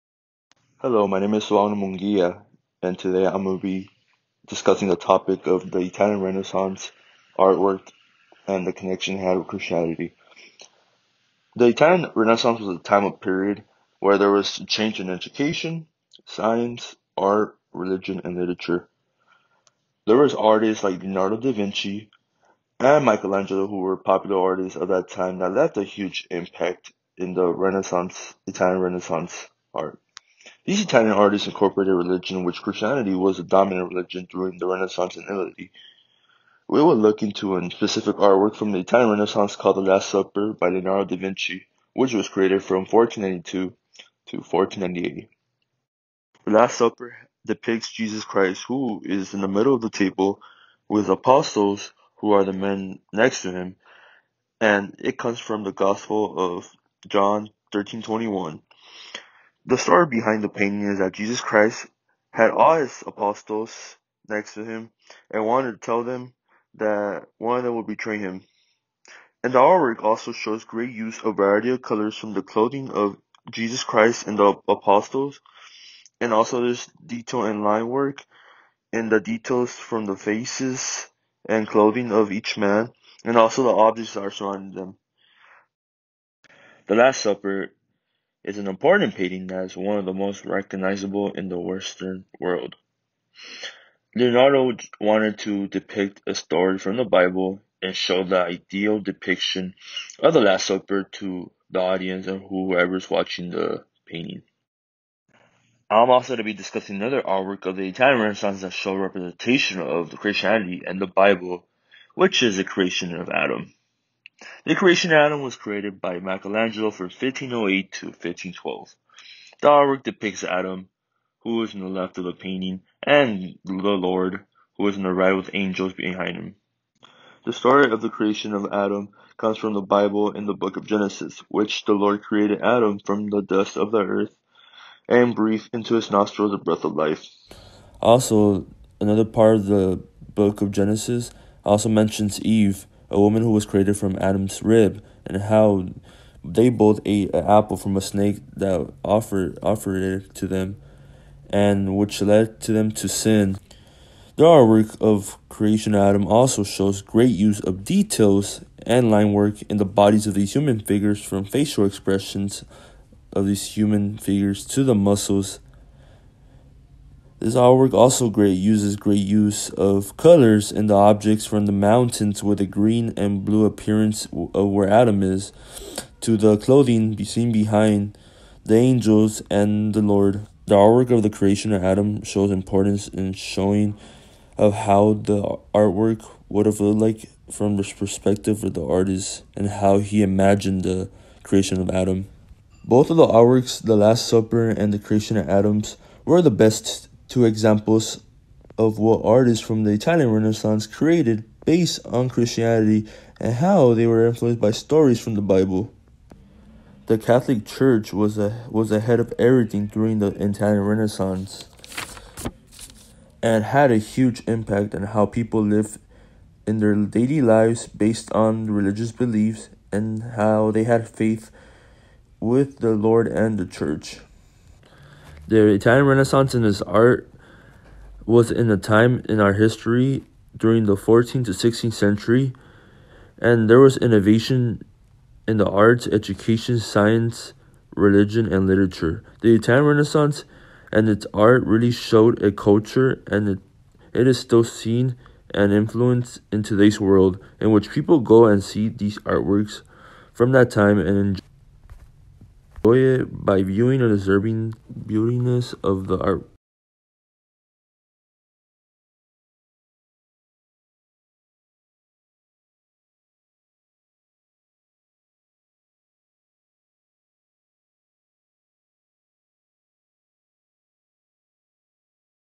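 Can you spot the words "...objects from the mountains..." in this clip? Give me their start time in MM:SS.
02:50.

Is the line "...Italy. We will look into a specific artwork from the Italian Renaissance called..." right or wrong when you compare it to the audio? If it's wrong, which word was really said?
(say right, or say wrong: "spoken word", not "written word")
right.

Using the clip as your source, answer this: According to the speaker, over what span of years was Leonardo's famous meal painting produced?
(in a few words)
1492 to 1498.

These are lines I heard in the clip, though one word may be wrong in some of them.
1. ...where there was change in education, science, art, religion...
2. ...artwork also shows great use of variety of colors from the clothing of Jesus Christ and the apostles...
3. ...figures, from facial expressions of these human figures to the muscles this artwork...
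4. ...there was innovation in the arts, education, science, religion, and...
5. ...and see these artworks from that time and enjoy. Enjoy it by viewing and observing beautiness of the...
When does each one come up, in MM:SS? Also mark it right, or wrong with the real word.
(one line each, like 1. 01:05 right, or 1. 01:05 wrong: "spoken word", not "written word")
1. 00:13 right
2. 01:09 right
3. 02:40 right
4. 03:53 right
5. 04:08 right.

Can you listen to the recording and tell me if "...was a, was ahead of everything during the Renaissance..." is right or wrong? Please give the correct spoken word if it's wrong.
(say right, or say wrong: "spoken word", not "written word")
wrong: "Italian", not "Renaissance".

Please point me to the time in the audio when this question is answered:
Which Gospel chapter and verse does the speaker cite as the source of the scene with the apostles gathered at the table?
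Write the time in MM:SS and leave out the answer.
00:57.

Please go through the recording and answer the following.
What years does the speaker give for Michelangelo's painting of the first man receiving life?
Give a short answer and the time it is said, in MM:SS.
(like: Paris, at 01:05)
1508 to 1512, at 01:57.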